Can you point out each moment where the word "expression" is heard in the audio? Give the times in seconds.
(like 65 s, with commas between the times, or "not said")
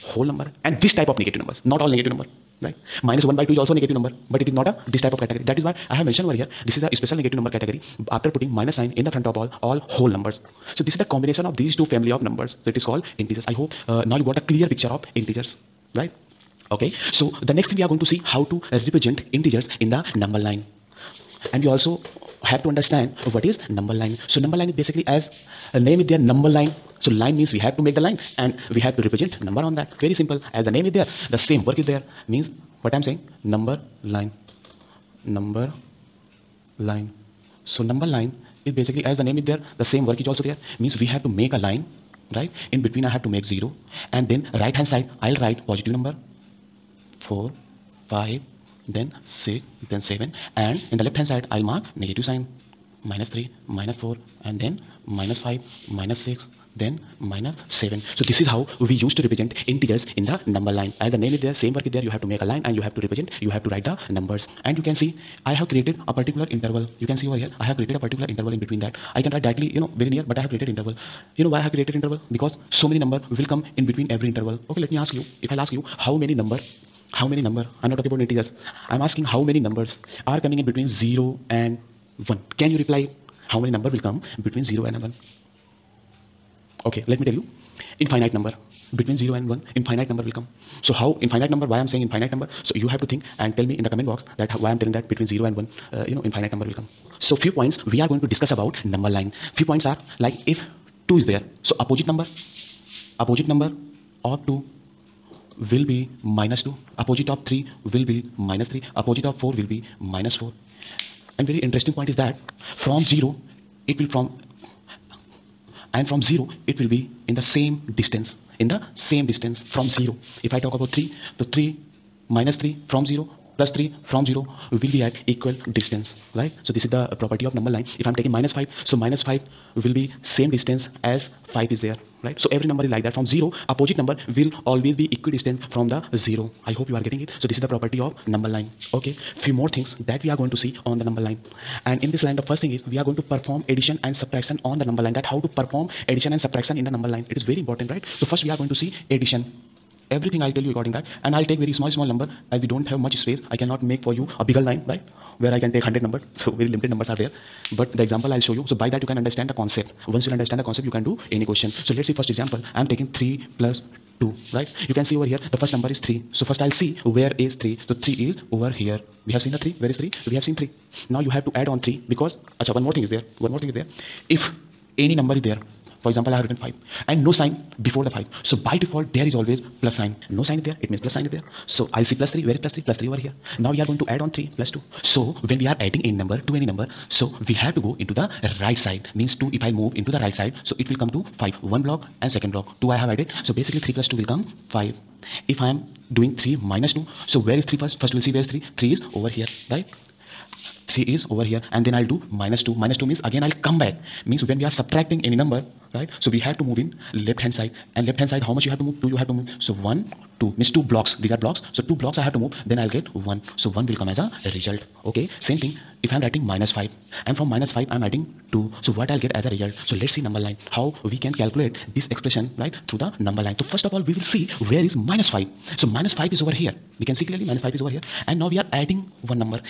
222 s.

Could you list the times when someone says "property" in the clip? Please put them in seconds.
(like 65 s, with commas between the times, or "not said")
127 s, 137 s.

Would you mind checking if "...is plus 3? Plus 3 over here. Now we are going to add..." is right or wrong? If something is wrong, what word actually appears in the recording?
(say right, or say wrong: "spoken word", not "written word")
right.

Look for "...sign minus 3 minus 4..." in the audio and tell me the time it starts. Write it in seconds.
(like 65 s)
52 s.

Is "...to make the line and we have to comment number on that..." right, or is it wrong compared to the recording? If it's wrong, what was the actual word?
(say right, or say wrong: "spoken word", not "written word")
wrong: "represent", not "comment".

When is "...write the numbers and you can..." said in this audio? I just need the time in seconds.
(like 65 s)
63 s.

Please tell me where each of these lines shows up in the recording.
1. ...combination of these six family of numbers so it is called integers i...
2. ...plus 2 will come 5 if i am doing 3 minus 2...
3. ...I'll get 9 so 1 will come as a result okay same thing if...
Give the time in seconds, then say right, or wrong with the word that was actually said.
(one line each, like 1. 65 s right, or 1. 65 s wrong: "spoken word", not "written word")
1. 11 s wrong: "two", not "six"
2. 193 s right
3. 212 s wrong: "1", not "9".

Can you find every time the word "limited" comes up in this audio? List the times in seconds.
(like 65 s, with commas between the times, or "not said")
156 s.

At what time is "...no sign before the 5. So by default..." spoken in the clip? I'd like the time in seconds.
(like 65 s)
177 s.